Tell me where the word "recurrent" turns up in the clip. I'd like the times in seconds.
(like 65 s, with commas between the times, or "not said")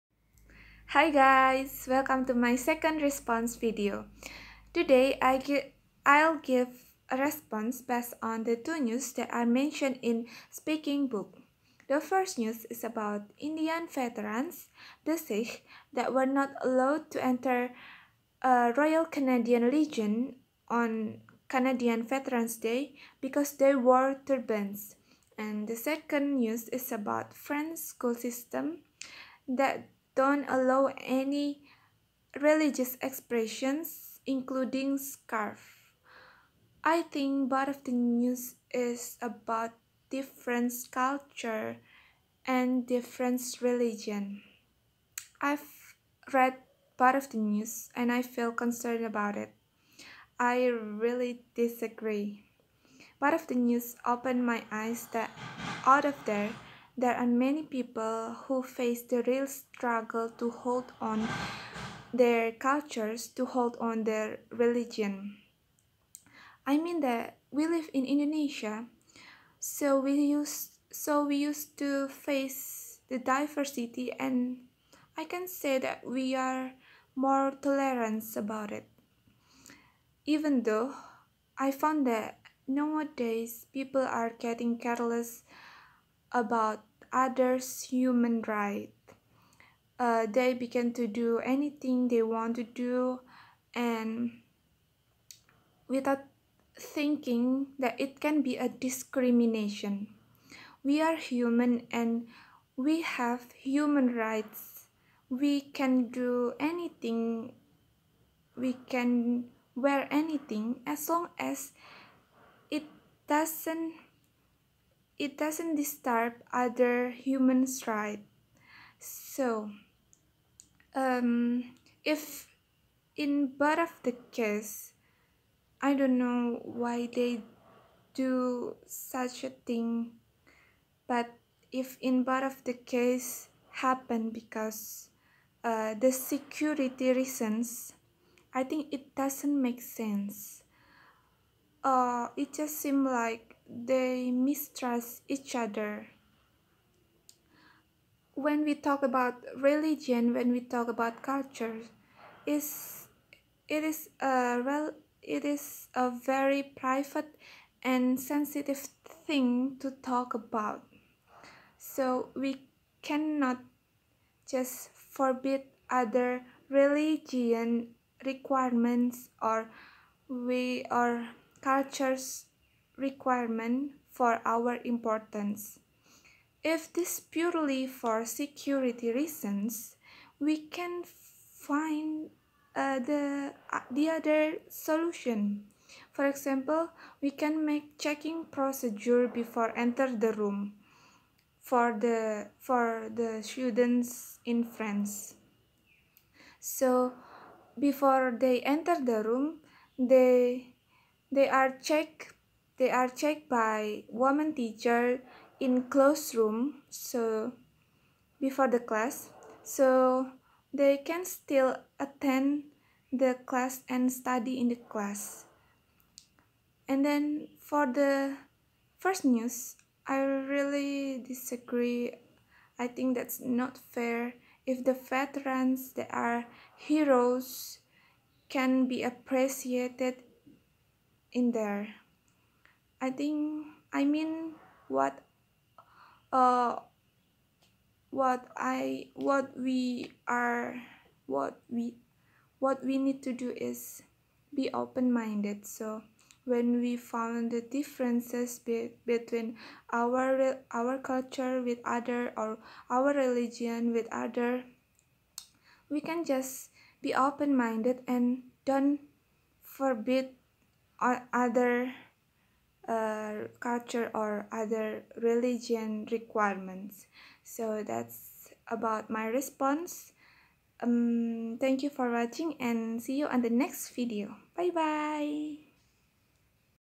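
not said.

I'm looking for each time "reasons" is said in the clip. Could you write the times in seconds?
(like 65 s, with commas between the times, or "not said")
137 s, 179 s.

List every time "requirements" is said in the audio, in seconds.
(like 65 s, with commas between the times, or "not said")
168 s, 173 s, 266 s.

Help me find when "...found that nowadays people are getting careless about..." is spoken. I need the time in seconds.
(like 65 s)
81 s.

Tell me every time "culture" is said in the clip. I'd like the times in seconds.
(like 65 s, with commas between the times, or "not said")
40 s, 62 s, 151 s, 171 s, 251 s, 263 s.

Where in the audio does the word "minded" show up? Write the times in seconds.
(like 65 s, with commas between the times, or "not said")
244 s, 257 s.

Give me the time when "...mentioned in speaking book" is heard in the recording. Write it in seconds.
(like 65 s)
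9 s.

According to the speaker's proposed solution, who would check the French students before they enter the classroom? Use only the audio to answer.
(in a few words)
woman teacher.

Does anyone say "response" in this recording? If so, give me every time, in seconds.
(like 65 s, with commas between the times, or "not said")
3 s, 7 s, 269 s.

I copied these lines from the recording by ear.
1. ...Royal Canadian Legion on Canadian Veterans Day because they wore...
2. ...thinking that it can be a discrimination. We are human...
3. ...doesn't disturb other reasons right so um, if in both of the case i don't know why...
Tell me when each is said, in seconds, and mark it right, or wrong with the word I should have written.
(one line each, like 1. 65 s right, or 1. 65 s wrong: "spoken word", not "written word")
1. 18 s right
2. 96 s right
3. 115 s wrong: "humans", not "reasons".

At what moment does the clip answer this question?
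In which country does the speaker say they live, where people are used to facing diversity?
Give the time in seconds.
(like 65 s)
68 s.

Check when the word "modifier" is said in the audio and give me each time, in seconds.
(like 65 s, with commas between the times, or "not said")
not said.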